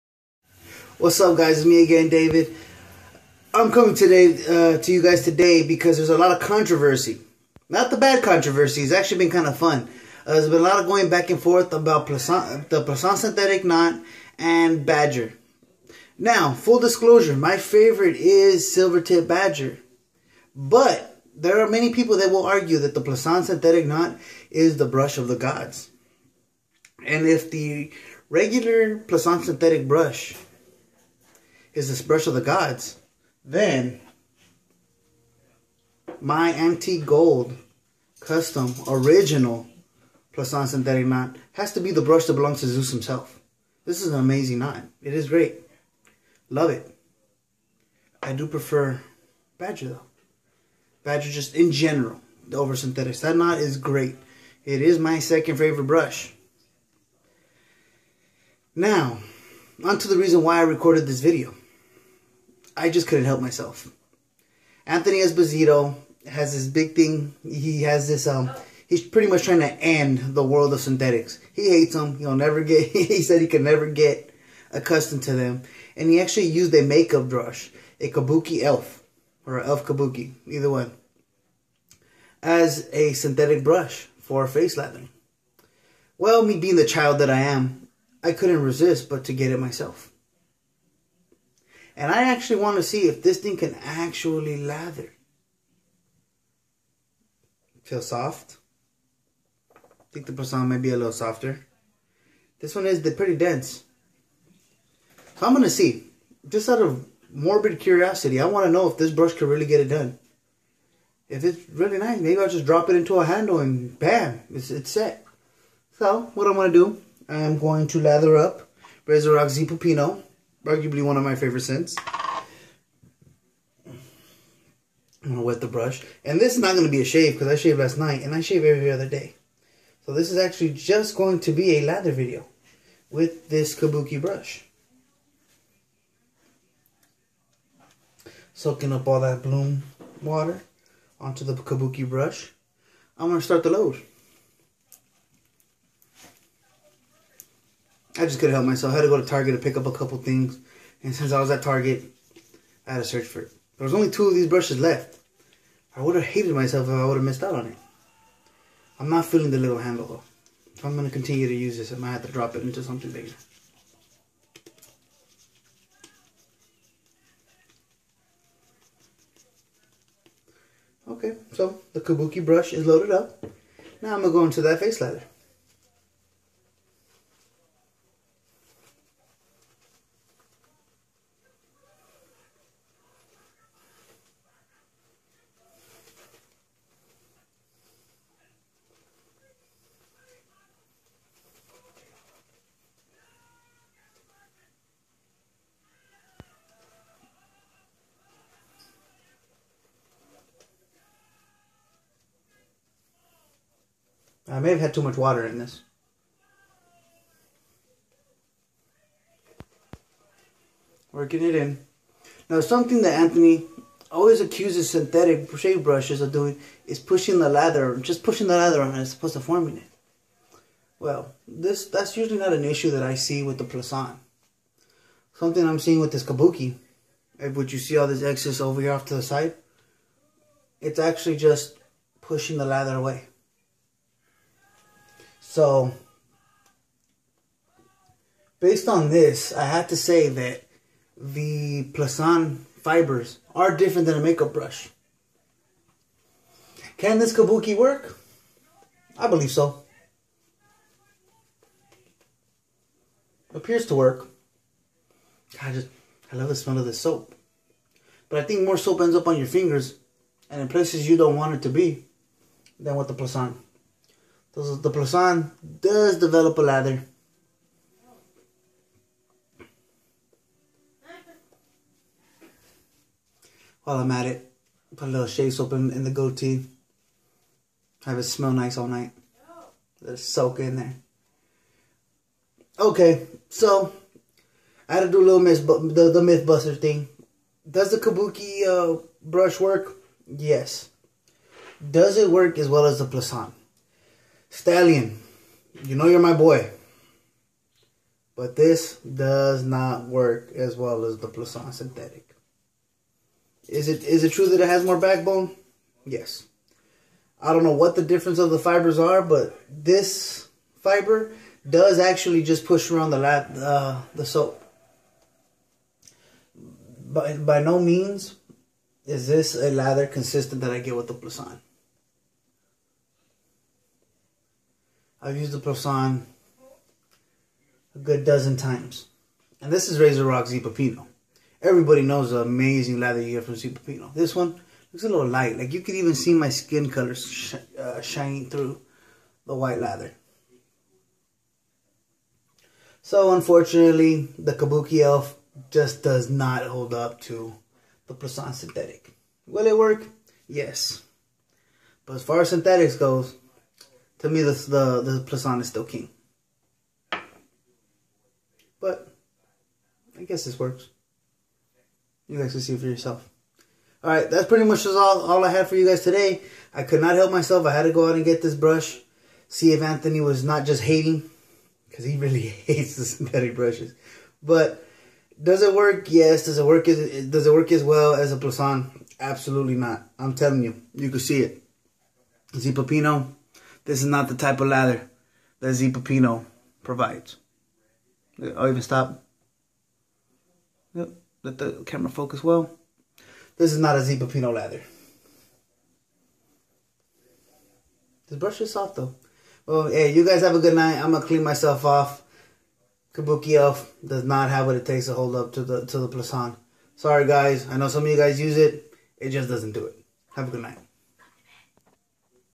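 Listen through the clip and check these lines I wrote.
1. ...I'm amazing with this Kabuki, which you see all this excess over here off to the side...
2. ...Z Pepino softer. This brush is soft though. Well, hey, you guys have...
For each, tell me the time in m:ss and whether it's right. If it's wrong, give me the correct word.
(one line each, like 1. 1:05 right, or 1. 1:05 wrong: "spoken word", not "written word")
1. 3:45 wrong: "seeing", not "amazing"
2. 6:34 wrong: "lather", not "softer".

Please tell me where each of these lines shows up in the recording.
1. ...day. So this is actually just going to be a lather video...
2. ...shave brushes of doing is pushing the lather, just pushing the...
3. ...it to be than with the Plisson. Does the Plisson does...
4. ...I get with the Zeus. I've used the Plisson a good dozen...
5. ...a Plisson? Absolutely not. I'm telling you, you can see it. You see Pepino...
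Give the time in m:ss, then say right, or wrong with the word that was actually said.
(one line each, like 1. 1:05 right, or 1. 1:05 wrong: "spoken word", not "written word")
1. 2:09 right
2. 3:35 right
3. 4:21 right
4. 5:20 wrong: "Plisson", not "Zeus"
5. 6:18 right.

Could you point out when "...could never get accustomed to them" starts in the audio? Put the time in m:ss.
1:13.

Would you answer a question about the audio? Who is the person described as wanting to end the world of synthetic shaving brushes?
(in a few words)
Anthony Esposito.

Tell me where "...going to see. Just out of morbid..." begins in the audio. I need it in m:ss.
1:45.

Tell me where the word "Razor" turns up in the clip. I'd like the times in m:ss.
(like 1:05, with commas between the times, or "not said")
1:59, 5:29.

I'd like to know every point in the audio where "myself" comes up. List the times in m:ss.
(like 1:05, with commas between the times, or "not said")
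1:03, 1:29, 2:28, 2:36, 6:07, 6:41.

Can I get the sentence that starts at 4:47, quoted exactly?
Does the kabuki uh, brush work?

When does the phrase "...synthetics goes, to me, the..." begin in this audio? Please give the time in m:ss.
5:52.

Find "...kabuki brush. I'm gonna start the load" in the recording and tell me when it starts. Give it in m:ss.
2:21.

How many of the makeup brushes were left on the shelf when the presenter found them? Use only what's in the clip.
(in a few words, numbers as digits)
2.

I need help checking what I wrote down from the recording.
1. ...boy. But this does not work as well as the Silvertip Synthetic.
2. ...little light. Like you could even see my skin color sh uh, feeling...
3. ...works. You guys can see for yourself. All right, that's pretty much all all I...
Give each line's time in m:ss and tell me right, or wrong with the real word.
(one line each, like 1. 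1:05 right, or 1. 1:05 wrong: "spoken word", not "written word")
1. 4:56 wrong: "Plisson", not "Silvertip"
2. 5:35 wrong: "shining", not "feeling"
3. 6:00 right.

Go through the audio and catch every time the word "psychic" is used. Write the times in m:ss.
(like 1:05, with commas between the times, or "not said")
not said.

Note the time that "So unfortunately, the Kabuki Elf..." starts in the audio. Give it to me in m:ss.
5:43.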